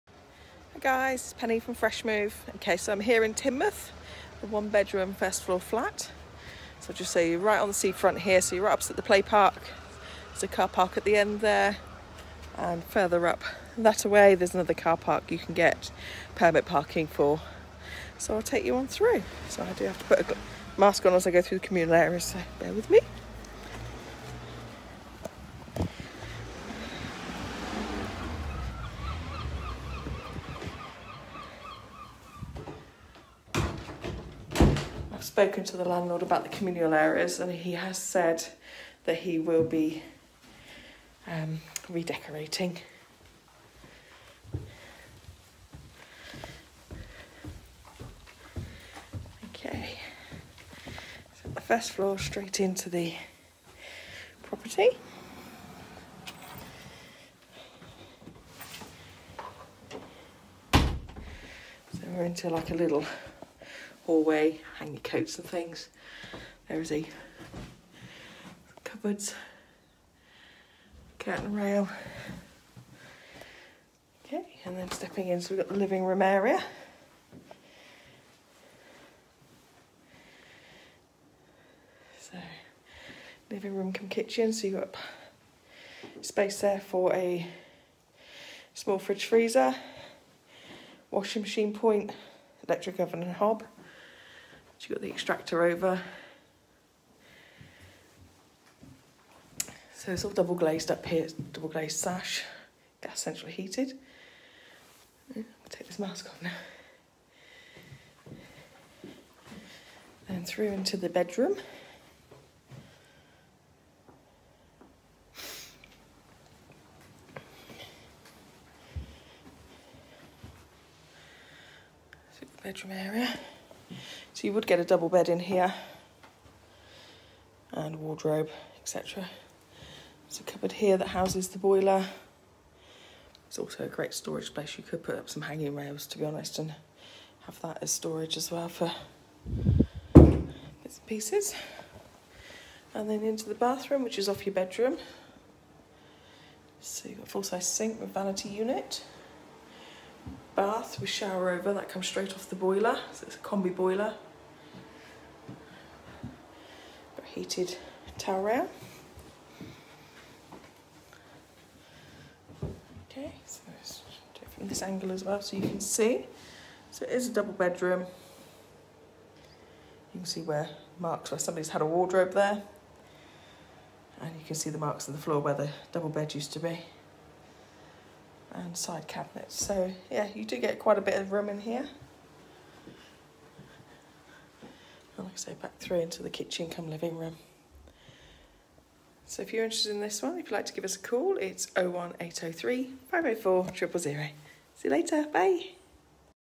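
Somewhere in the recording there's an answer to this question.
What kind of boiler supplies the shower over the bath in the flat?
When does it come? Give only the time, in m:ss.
2:33.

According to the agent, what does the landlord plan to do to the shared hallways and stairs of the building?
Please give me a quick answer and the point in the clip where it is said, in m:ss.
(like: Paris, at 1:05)
Redecorating, at 0:41.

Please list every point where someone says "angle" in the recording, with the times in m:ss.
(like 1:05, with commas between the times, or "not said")
2:44.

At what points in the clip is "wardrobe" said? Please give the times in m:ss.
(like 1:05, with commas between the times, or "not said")
2:07, 2:51.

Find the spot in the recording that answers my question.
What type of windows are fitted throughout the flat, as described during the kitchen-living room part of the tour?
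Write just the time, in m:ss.
1:41.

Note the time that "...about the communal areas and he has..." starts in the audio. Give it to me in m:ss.
0:36.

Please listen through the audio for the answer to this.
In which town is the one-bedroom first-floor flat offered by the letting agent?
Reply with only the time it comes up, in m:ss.
0:03.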